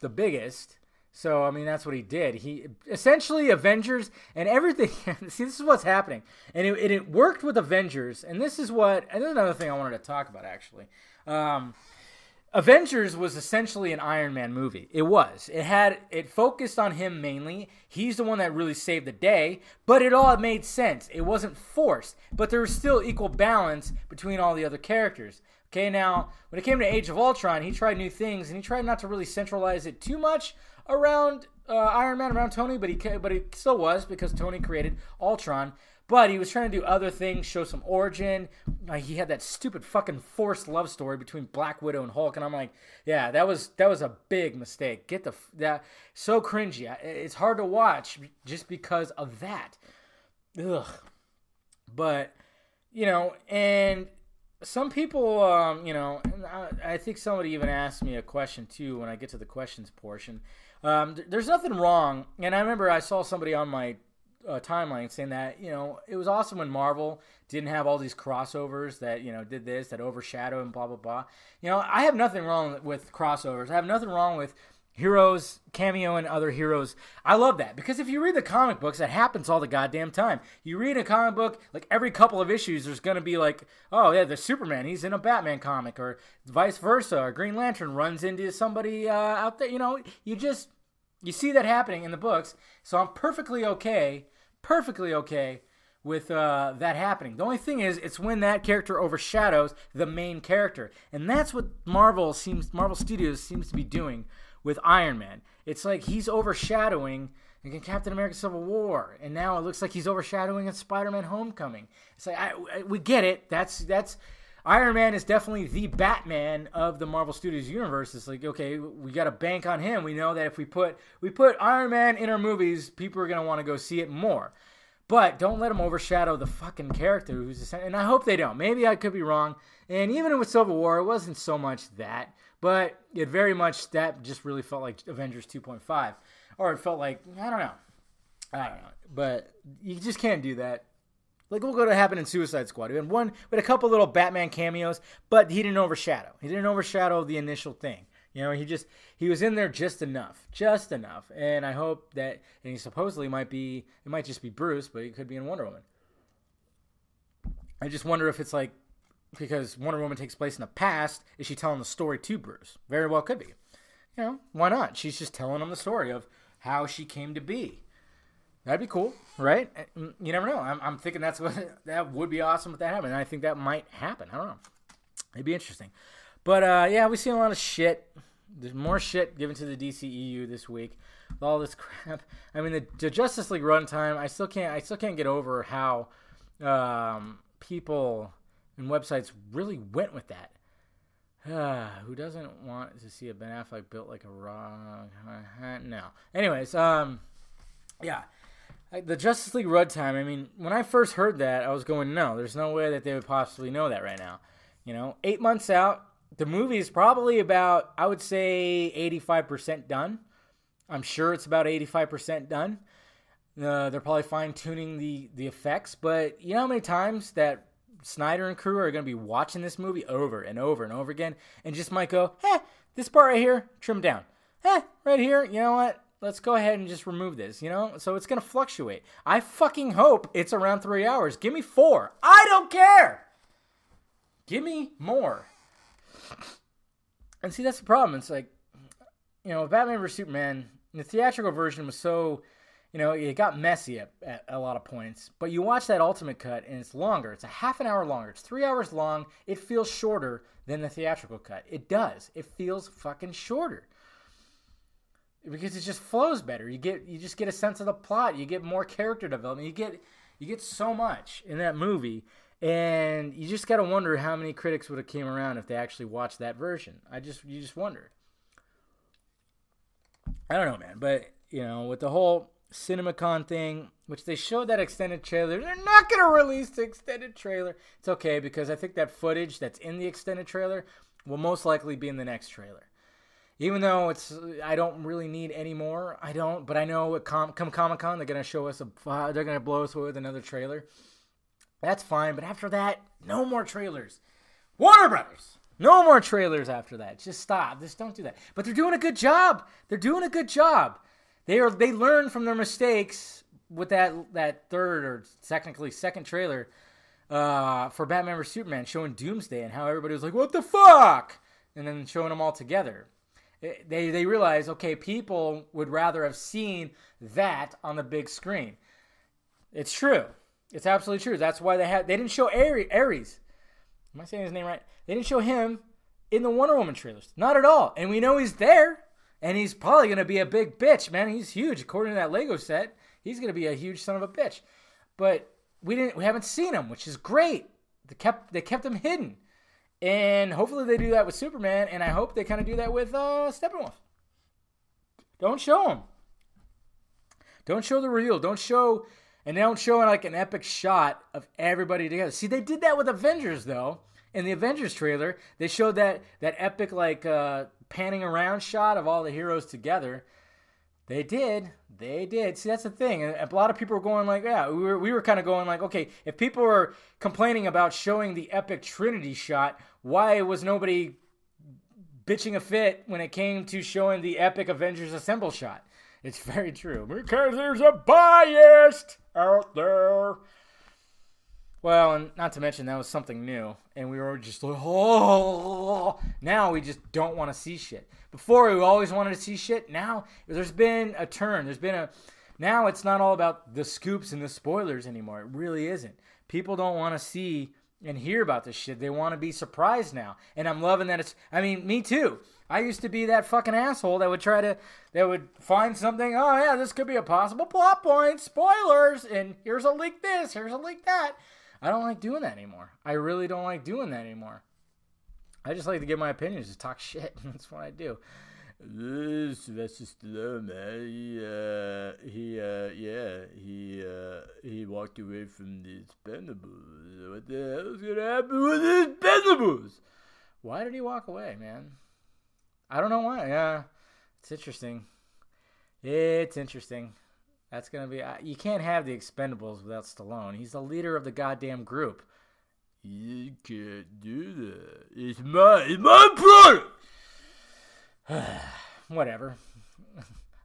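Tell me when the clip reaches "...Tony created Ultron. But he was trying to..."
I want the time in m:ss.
0:34.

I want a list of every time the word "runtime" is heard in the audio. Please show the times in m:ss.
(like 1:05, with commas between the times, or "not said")
3:03, 3:19.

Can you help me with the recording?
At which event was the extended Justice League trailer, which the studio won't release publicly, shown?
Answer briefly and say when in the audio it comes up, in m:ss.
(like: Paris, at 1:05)
CinemaCon, at 4:32.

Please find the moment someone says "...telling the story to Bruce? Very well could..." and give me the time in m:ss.
2:41.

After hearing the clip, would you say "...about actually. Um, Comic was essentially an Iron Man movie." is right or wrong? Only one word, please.
wrong.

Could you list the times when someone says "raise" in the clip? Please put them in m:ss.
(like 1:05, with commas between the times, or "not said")
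not said.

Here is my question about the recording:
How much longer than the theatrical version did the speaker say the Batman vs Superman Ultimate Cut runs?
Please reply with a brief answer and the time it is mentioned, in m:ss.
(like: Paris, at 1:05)
half an hour, at 4:07.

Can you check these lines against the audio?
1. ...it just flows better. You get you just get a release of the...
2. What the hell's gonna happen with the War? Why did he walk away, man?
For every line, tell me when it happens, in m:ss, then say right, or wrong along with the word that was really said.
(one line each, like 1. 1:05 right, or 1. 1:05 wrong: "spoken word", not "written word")
1. 4:15 wrong: "sense", not "release"
2. 7:07 wrong: "Expendables", not "War".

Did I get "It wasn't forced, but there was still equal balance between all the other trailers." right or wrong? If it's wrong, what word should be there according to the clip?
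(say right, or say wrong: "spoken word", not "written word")
wrong: "characters", not "trailers".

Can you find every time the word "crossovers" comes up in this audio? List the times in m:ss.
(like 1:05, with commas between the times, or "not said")
1:08, 1:13.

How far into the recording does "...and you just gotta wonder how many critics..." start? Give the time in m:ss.
4:22.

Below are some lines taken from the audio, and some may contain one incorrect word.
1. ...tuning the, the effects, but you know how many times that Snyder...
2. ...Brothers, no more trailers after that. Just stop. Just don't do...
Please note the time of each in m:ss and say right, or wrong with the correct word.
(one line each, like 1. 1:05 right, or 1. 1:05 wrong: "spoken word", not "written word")
1. 3:34 right
2. 4:55 right.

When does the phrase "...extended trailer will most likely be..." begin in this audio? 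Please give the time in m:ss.
4:40.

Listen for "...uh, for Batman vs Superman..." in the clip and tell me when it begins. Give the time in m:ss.
5:07.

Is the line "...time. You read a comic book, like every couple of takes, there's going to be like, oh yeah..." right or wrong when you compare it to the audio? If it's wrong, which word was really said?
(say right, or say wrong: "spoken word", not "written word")
wrong: "issues", not "takes".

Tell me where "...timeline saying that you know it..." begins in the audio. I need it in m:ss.
1:04.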